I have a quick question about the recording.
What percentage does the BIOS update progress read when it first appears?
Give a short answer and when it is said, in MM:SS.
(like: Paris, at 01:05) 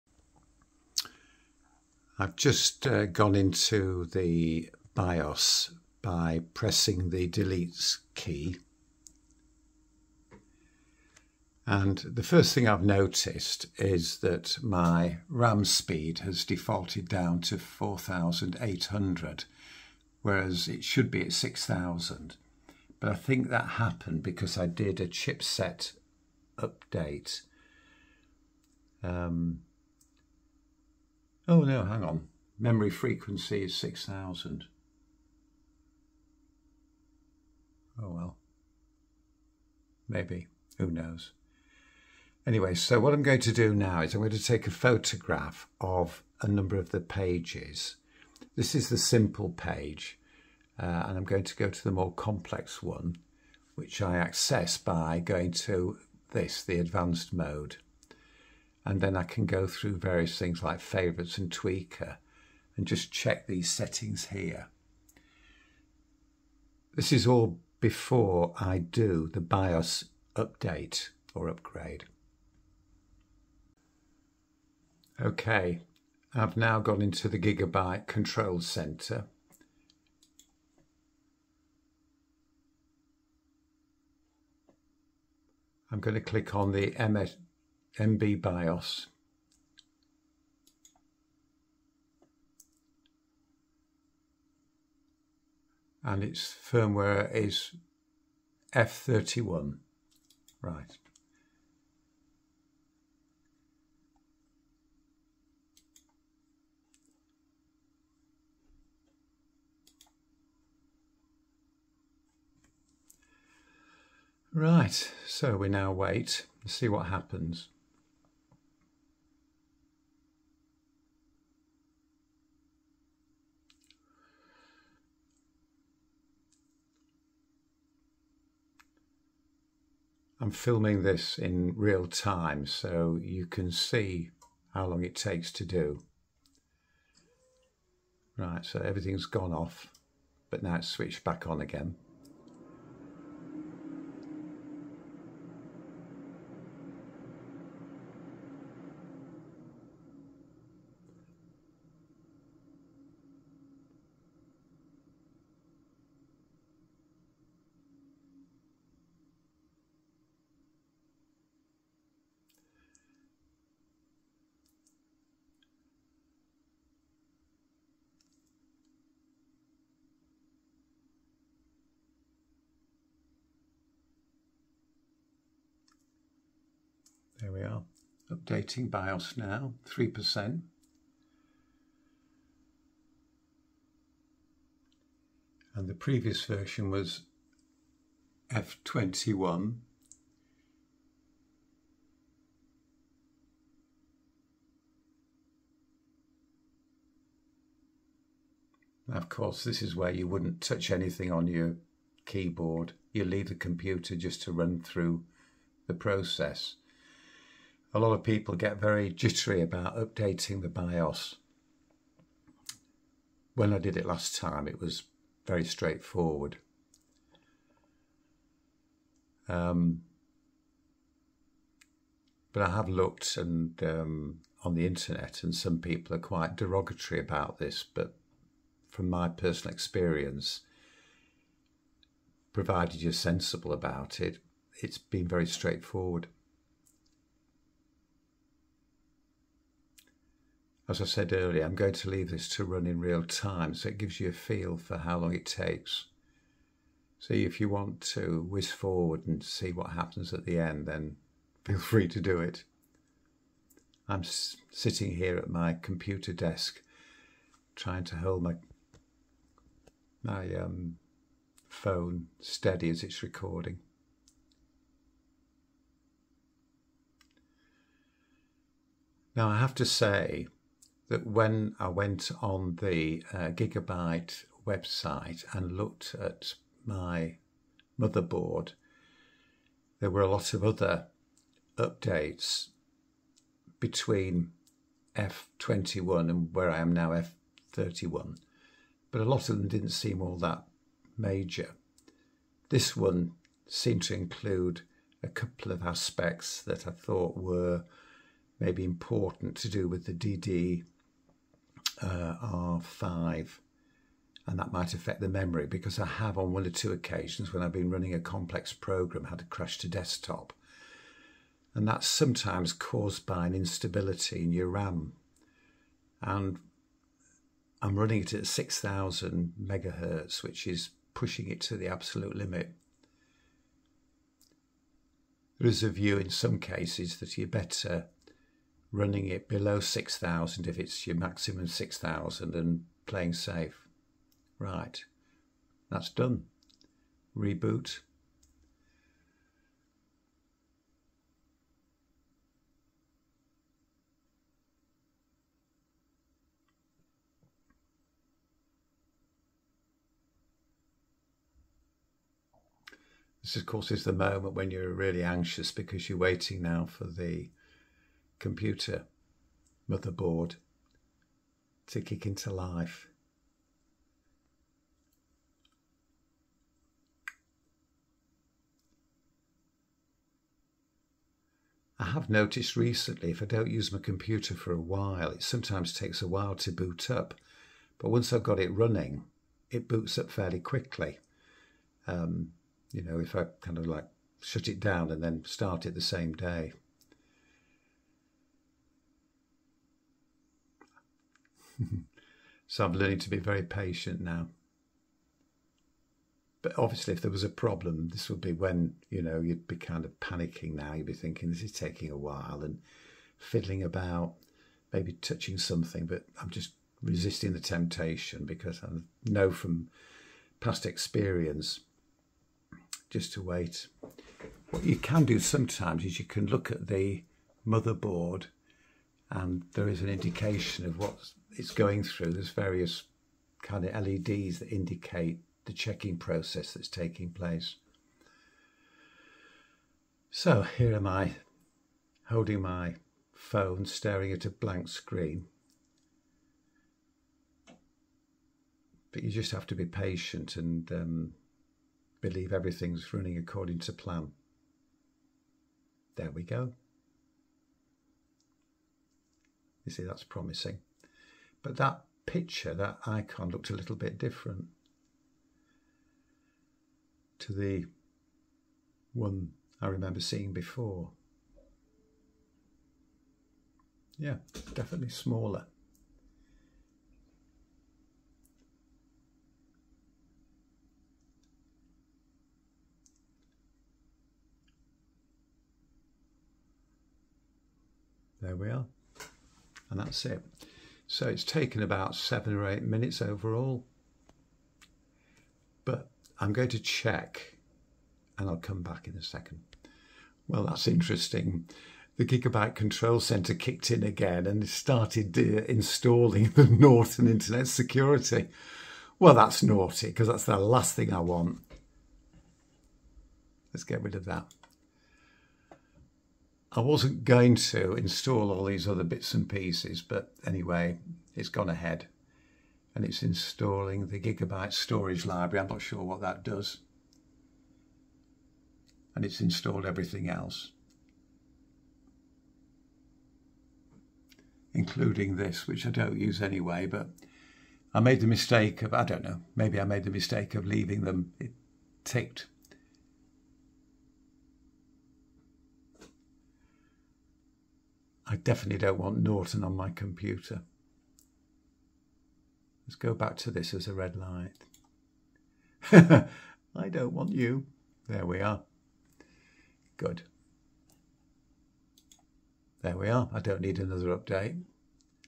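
3%, at 02:59.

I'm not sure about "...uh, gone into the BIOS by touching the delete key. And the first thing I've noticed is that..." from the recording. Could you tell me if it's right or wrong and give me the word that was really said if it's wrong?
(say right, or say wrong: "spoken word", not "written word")
wrong: "pressing", not "touching".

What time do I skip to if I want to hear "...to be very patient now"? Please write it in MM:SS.
06:33.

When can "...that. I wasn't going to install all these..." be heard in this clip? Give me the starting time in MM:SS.
08:24.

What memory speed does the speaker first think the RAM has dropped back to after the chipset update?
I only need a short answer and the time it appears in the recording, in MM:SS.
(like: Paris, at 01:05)
4800, at 00:17.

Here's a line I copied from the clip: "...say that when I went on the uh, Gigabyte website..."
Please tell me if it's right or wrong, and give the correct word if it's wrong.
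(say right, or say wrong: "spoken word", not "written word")
right.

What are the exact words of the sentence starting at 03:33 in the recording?
When I did it last time, it was very straightforward.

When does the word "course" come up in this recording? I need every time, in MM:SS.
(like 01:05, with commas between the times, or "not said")
03:19, 05:53.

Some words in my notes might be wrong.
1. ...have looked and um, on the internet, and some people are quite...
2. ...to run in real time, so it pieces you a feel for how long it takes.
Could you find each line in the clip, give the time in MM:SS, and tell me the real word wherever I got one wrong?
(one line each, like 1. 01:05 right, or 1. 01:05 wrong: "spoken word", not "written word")
1. 03:42 right
2. 04:02 wrong: "gives", not "pieces".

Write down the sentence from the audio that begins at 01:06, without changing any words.
This is all before I do the BIOS update or upgrade.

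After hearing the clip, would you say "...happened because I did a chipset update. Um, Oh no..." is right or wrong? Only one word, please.
right.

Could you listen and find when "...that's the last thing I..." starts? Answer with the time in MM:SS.
08:20.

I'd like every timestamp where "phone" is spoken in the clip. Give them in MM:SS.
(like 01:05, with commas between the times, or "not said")
04:21, 07:13.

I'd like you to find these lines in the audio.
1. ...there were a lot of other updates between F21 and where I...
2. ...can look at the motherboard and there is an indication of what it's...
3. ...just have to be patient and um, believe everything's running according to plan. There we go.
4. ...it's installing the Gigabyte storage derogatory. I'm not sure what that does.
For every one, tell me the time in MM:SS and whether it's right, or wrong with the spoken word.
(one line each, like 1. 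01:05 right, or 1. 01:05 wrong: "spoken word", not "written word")
1. 04:39 right
2. 06:56 right
3. 07:19 right
4. 08:33 wrong: "library", not "derogatory".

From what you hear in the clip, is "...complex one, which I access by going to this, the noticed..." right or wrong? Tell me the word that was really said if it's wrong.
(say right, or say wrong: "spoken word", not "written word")
wrong: "advanced", not "noticed".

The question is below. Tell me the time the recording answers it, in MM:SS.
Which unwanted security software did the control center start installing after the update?
08:16.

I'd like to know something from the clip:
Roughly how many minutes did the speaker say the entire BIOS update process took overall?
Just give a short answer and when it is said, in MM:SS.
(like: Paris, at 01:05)
7 or 8 minutes, at 08:02.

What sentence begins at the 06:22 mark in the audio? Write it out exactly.
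Um, you know, if I kind of like shut it down and then start it the same day.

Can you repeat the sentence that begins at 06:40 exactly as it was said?
Now you'd be thinking this is taking a while and fiddling about, maybe touching something.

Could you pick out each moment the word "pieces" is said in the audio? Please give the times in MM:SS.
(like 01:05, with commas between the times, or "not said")
08:29.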